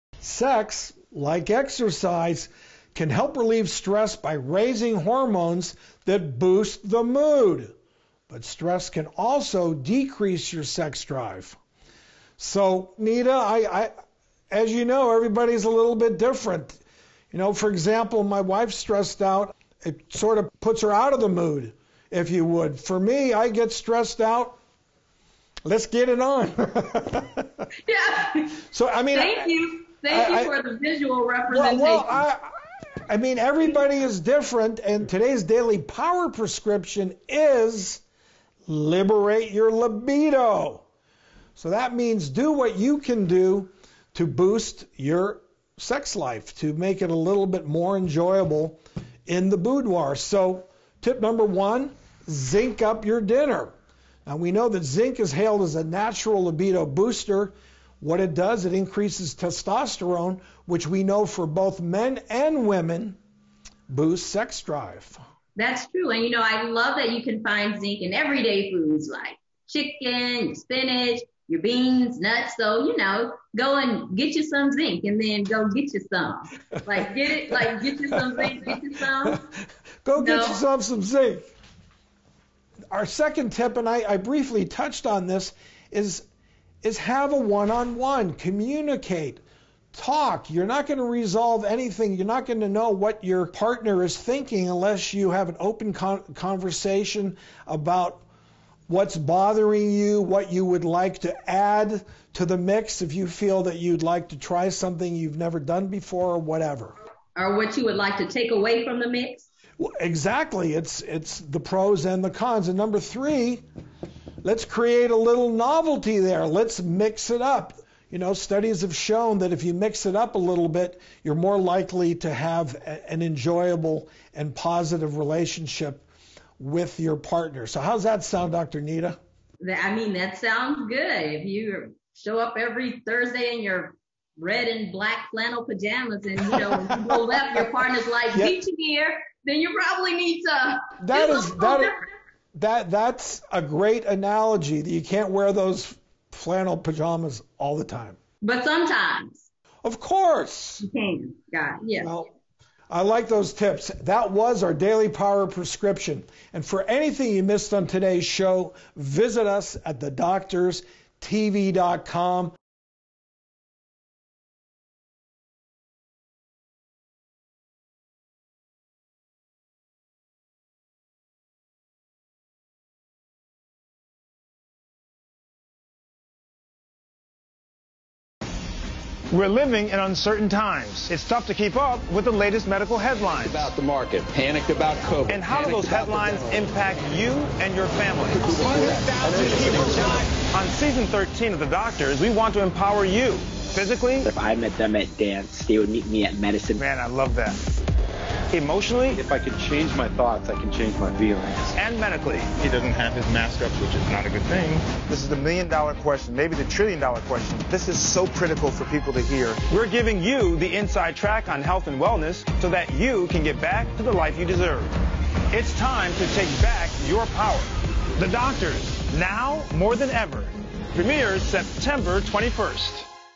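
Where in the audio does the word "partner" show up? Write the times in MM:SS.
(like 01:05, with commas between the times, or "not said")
01:33, 02:07, 02:17.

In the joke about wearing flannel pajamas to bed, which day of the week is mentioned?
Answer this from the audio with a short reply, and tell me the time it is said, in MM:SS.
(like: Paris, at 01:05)
Thursday, at 02:13.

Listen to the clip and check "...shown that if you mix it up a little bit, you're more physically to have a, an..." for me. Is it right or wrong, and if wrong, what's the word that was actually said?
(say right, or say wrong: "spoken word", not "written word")
wrong: "likely", not "physically".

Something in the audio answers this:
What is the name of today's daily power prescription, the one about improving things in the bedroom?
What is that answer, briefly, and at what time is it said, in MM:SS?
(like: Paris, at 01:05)
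Liberate your libido, at 00:38.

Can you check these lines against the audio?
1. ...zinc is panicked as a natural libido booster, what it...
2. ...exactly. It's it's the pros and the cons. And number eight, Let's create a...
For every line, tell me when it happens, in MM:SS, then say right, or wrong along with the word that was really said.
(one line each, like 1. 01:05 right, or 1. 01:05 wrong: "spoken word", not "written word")
1. 00:54 wrong: "hailed", not "panicked"
2. 01:49 wrong: "three", not "eight".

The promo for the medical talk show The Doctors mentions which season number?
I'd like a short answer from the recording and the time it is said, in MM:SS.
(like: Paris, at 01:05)
13, at 03:11.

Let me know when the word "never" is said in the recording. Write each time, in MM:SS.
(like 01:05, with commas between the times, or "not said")
01:45.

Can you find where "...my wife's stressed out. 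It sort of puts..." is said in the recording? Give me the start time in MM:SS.
00:18.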